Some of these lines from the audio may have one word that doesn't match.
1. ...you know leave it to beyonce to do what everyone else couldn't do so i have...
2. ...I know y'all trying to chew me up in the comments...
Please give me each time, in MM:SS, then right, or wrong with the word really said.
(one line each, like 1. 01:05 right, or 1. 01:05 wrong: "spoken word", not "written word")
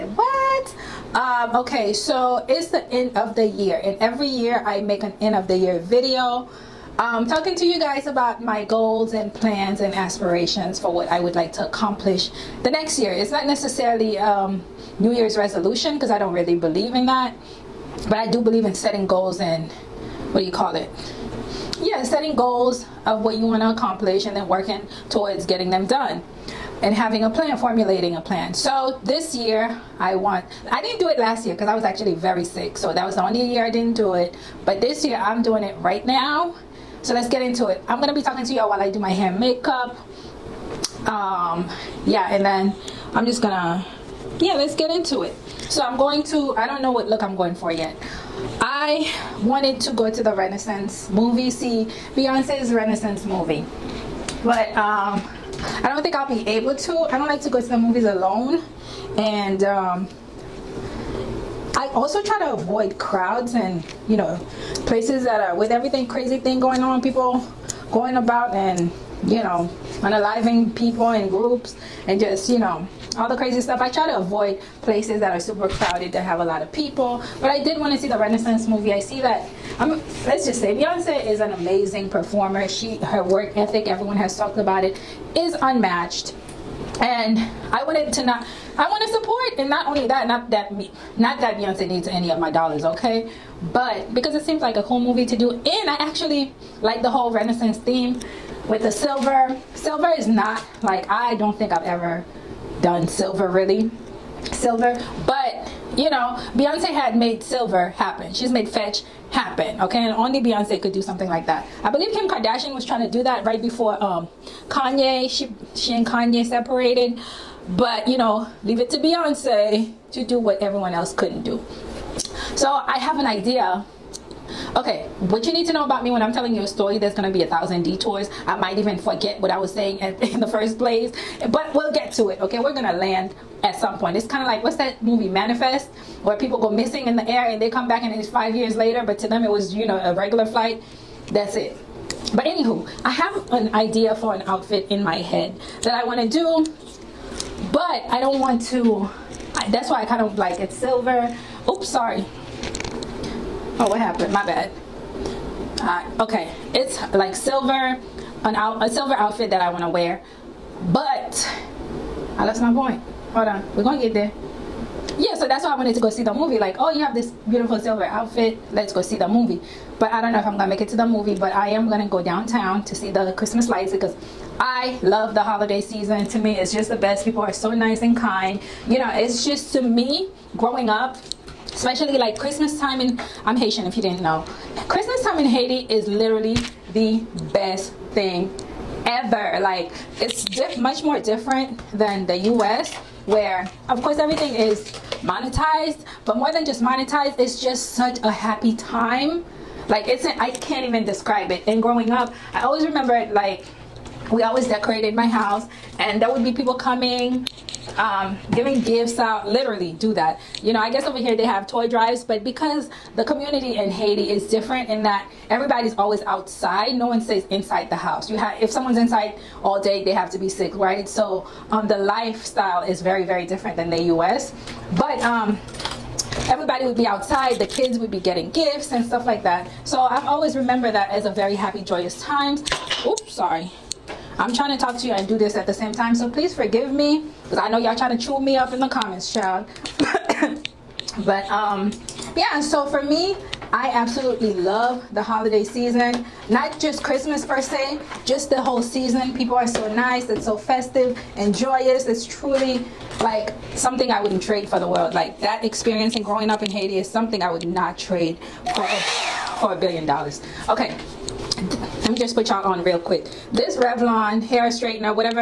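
1. 01:58 right
2. 03:57 right.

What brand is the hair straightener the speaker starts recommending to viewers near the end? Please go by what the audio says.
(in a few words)
Revlon.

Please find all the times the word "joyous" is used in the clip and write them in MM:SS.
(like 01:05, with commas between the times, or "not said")
03:51, 04:11.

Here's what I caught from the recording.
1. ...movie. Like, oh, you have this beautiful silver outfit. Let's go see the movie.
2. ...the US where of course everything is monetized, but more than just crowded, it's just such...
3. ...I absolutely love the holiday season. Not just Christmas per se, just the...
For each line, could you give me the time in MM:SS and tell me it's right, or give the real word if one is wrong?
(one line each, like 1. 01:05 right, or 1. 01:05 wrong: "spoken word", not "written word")
1. 02:46 right
2. 03:12 wrong: "monetized", not "crowded"
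3. 04:03 right.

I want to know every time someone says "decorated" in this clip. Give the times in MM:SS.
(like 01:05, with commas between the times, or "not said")
03:24.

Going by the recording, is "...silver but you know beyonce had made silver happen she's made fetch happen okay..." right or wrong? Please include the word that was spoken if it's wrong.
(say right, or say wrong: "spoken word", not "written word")
right.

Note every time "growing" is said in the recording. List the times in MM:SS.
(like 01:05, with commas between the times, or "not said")
03:00, 03:21, 04:16.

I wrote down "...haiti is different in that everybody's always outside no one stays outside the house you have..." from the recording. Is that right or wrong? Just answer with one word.
wrong.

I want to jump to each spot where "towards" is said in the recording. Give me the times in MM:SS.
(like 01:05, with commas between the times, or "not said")
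00:25.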